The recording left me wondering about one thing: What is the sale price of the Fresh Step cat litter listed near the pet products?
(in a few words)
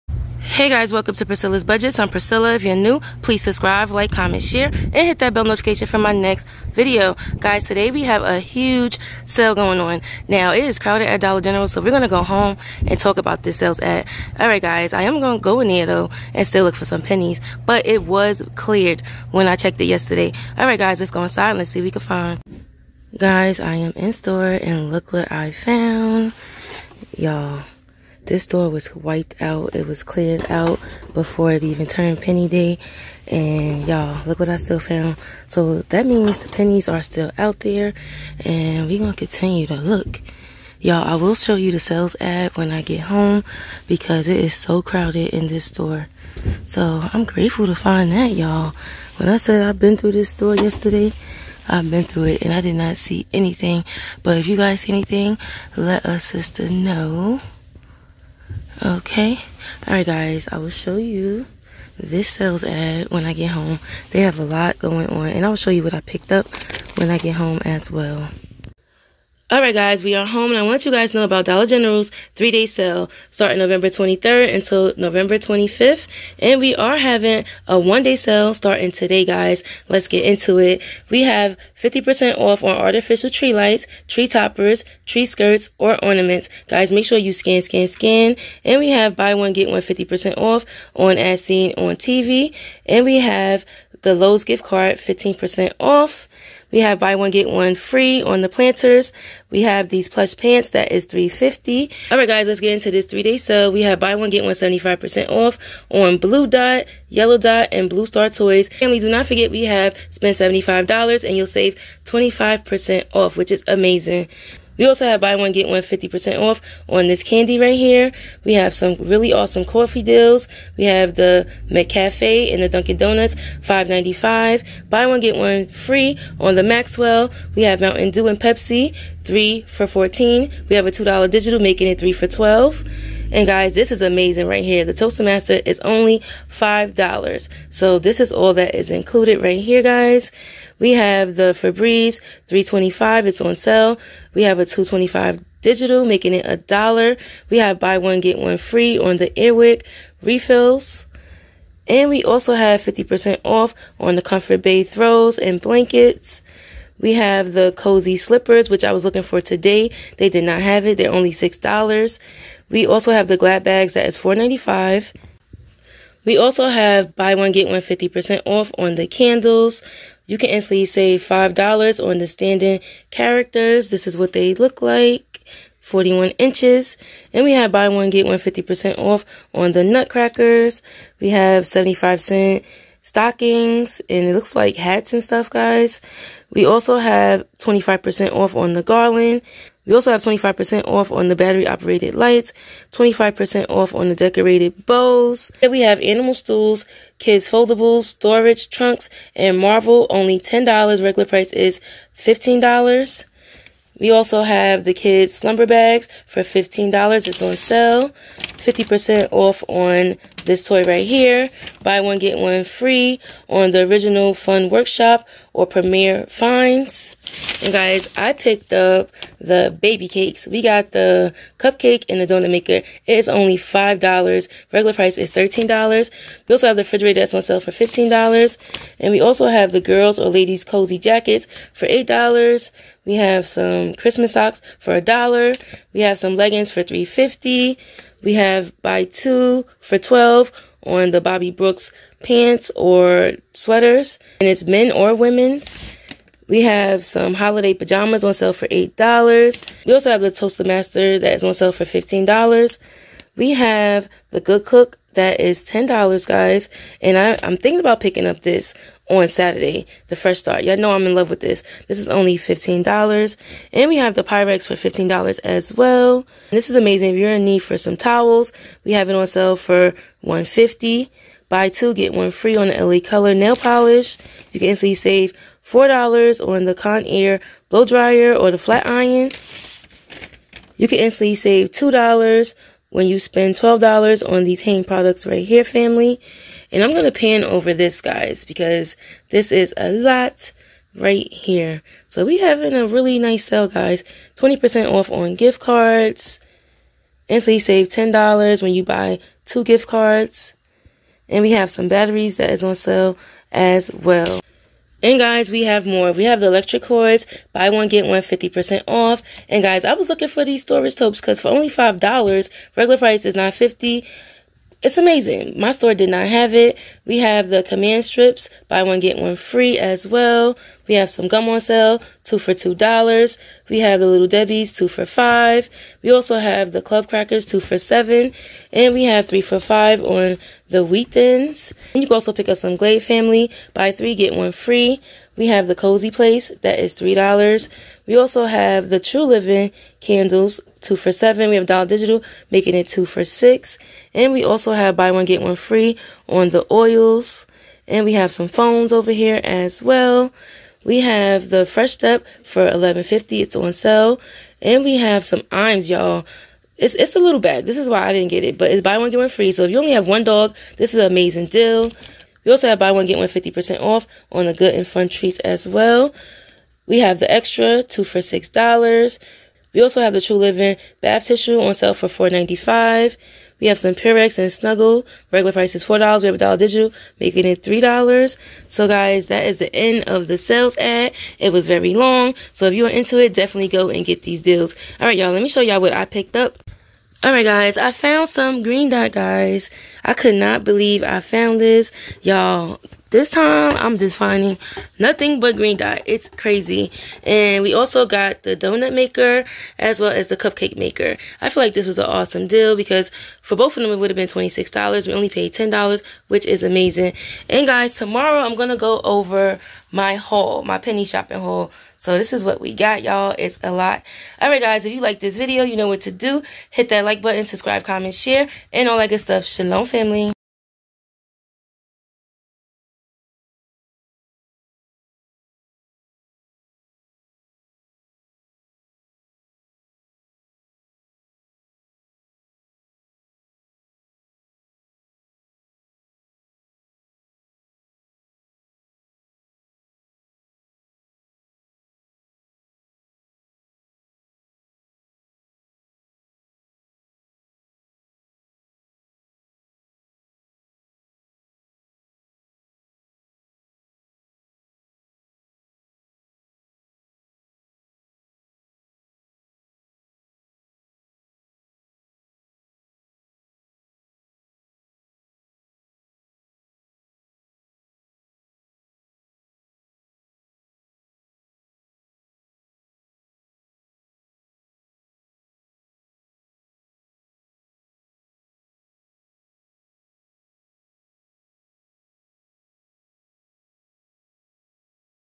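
$11.50.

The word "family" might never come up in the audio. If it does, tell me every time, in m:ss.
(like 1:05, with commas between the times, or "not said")
1:48, 4:45, 5:33, 6:59.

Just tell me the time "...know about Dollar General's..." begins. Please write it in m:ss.
1:11.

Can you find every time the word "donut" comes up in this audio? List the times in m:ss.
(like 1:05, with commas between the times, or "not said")
2:02, 3:42, 6:38.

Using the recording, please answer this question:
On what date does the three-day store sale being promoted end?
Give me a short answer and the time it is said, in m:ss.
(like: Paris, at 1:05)
November 25th, at 1:14.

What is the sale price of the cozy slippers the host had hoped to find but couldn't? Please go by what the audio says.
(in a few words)
$6.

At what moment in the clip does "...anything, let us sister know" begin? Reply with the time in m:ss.
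0:54.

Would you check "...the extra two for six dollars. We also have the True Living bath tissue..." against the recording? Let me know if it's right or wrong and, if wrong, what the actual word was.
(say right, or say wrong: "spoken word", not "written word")
right.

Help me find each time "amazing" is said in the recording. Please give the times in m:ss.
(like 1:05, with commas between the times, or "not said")
1:53, 2:14, 4:26, 5:14, 6:01, 6:46.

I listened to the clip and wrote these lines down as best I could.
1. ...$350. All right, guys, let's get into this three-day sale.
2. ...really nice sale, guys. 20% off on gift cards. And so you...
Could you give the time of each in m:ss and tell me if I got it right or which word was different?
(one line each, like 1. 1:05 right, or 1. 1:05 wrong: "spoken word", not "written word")
1. 1:41 right
2. 4:52 right.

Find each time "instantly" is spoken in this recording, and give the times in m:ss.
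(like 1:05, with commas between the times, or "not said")
2:50, 4:34, 4:40.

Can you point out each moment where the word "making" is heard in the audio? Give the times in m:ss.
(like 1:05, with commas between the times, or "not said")
2:11, 2:26, 5:42, 6:17.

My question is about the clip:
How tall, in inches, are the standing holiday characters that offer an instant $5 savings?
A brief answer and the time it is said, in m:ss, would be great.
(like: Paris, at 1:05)
41 inches, at 2:55.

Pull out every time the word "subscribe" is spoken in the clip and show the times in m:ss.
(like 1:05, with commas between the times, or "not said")
0:03, 6:57.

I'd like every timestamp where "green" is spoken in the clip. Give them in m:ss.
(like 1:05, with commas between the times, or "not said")
6:28, 6:35.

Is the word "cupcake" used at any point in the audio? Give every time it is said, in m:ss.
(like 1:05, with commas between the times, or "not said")
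3:41, 6:40.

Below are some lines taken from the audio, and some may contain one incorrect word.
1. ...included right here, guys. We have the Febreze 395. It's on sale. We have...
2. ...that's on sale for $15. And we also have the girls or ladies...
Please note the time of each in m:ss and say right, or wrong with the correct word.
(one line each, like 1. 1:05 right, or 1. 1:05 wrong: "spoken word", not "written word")
1. 2:18 wrong: "325", not "395"
2. 3:47 right.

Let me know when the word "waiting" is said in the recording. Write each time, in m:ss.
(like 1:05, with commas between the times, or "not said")
not said.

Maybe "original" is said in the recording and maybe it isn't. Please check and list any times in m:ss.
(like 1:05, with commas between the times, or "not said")
3:33.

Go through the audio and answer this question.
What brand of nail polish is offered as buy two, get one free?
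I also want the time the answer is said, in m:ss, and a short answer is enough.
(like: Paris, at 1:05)
LA Color, at 4:32.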